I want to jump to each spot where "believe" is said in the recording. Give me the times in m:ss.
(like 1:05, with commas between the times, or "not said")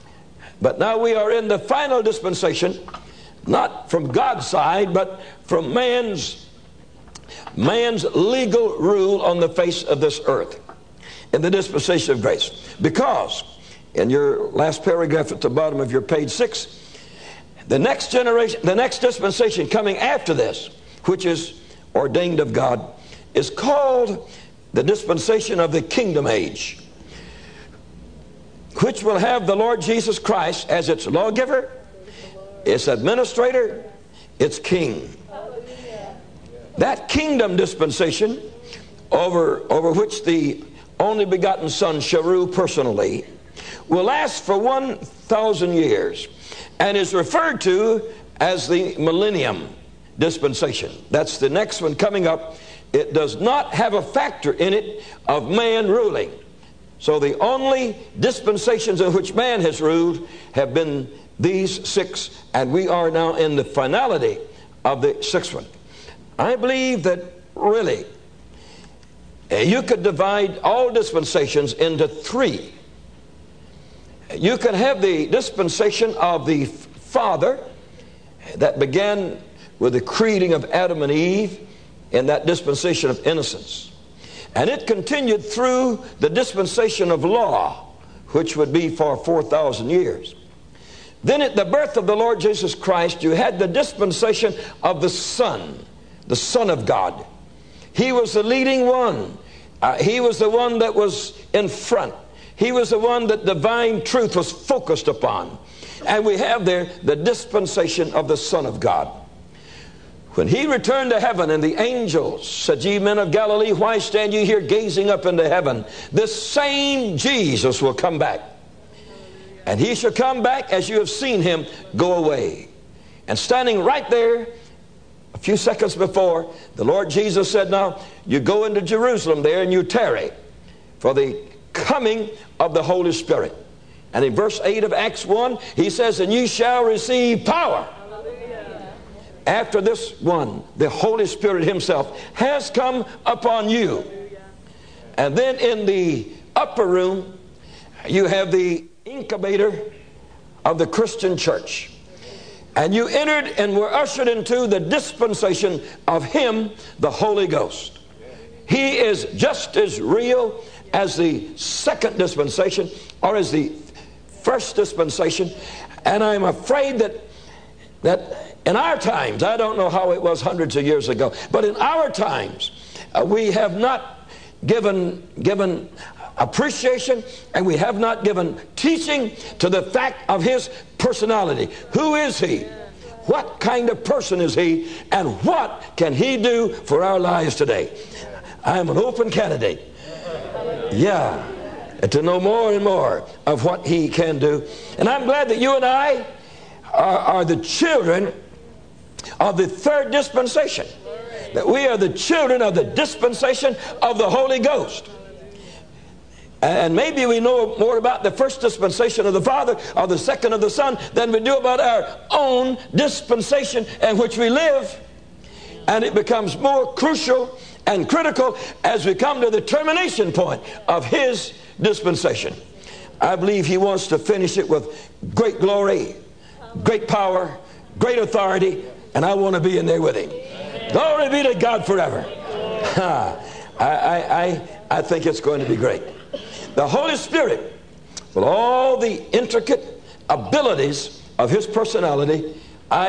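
1:06, 3:43.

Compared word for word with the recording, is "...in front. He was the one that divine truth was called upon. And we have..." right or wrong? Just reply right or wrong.
wrong.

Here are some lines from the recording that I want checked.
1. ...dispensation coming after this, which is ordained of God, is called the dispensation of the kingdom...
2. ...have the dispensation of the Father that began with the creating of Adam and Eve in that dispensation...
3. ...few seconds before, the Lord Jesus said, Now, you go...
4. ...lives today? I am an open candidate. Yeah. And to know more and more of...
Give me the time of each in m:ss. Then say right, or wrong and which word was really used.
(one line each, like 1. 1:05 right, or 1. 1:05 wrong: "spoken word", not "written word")
1. 0:18 right
2. 1:14 right
3. 2:05 right
4. 3:07 right.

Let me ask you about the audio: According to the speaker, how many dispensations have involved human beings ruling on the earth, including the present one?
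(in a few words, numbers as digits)
6.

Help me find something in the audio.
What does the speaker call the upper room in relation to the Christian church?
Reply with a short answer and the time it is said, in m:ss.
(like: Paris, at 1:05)
the incubator, at 2:28.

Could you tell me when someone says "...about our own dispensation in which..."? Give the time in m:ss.
3:31.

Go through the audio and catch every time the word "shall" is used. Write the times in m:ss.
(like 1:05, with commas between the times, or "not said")
0:41, 1:59, 2:16.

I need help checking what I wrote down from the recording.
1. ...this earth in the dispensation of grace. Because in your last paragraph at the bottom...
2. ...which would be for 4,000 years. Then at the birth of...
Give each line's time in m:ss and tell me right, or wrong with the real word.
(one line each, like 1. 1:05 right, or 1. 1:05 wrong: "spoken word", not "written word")
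1. 0:10 right
2. 1:28 right.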